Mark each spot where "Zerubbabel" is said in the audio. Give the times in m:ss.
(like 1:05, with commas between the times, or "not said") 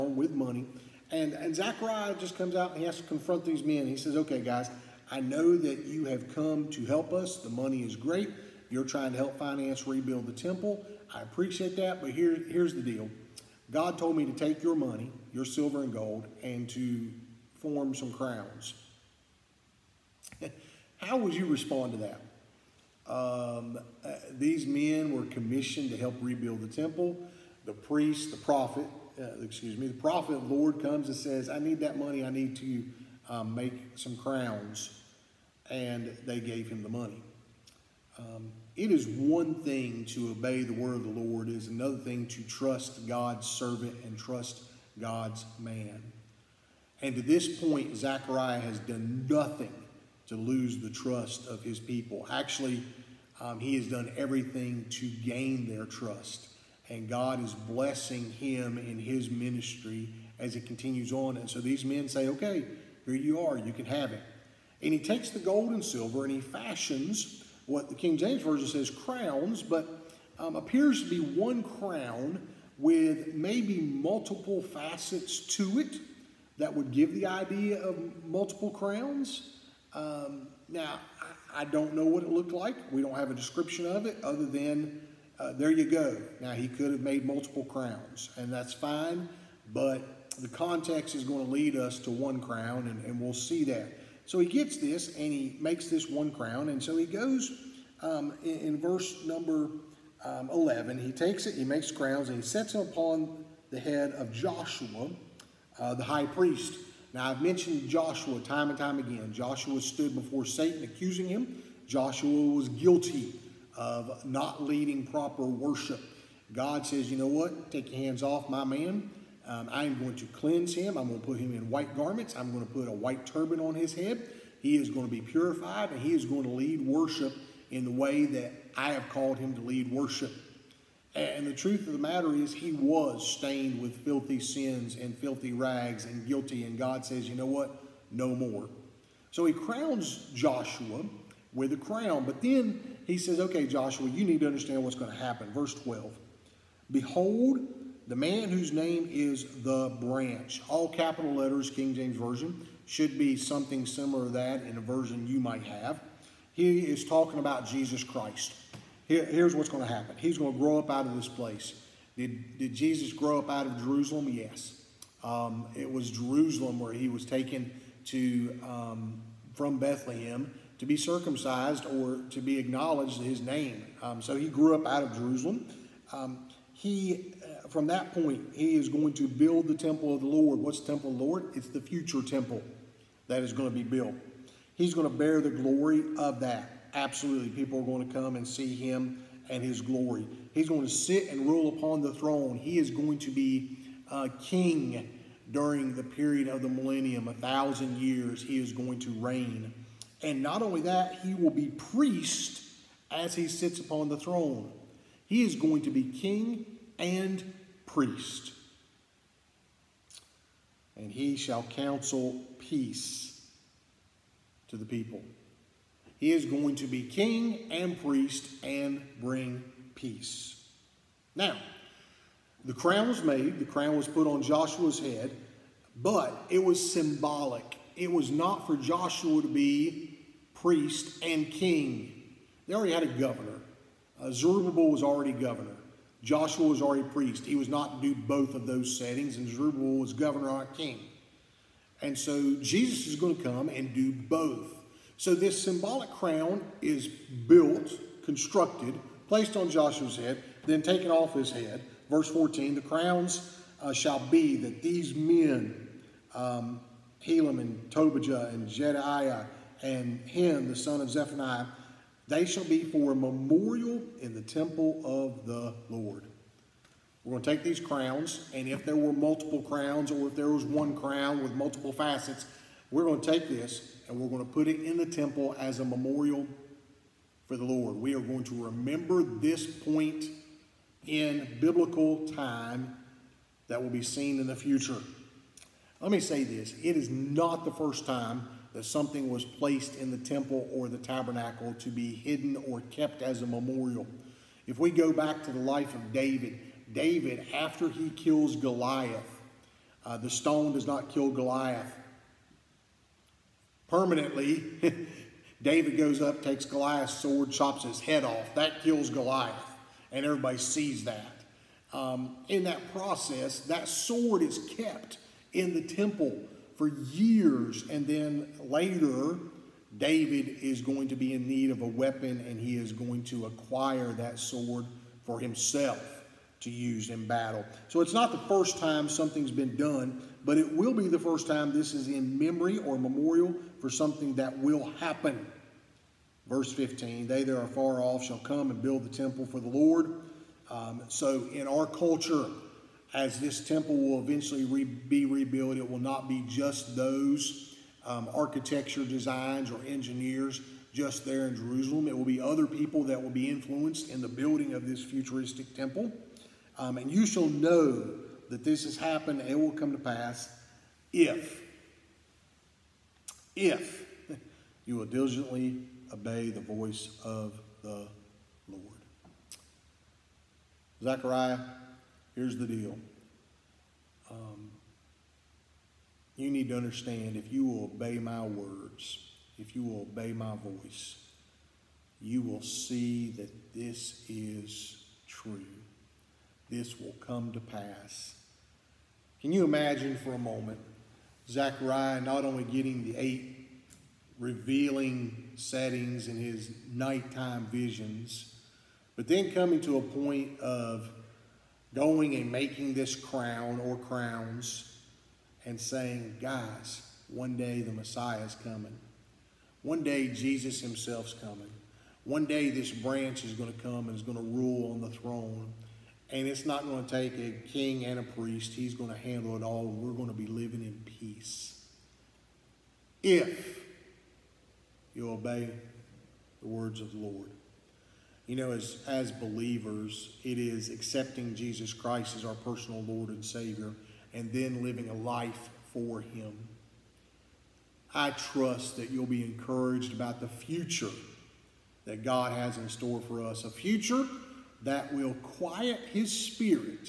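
3:54, 3:59.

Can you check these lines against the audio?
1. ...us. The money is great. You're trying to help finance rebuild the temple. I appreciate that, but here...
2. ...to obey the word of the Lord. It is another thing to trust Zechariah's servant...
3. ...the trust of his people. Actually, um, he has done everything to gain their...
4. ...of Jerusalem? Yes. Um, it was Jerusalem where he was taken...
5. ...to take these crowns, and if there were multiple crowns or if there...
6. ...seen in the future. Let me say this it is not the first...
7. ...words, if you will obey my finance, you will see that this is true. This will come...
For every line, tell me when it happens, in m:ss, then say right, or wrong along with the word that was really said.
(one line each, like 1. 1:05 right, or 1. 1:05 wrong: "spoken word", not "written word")
1. 0:07 right
2. 0:40 wrong: "God", not "Zechariah"
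3. 0:50 right
4. 2:43 right
5. 4:27 right
6. 4:44 right
7. 6:18 wrong: "voice", not "finance".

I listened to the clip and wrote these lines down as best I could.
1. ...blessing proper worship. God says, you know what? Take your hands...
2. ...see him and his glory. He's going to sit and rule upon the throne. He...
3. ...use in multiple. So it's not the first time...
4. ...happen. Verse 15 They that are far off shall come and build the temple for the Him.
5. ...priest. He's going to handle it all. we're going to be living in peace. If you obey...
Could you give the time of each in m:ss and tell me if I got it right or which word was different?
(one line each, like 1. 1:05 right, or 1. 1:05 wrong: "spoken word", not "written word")
1. 1:54 wrong: "leading", not "blessing"
2. 3:08 right
3. 5:26 wrong: "battle", not "multiple"
4. 5:35 wrong: "Lord", not "Him"
5. 6:58 right.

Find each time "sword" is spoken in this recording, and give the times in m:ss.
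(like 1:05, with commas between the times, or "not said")
5:07, 5:13, 5:24.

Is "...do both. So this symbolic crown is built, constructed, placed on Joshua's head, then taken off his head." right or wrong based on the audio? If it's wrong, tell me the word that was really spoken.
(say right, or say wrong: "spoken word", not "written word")
right.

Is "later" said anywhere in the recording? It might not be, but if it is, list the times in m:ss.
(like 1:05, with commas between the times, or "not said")
5:18.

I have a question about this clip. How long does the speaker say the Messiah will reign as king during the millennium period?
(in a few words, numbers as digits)
1000 years.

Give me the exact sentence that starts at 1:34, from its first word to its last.
So he gets this, and he makes this one crown, and so he goes um, in, in, verse number um, 11.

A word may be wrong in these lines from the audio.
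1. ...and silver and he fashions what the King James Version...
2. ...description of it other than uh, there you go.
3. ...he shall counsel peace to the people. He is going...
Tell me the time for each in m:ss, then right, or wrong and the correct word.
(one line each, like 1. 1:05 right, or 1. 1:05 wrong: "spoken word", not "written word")
1. 1:05 right
2. 1:23 right
3. 3:31 right.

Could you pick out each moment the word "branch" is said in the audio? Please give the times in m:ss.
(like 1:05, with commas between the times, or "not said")
2:29, 6:52.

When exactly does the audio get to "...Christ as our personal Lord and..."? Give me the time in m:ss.
7:11.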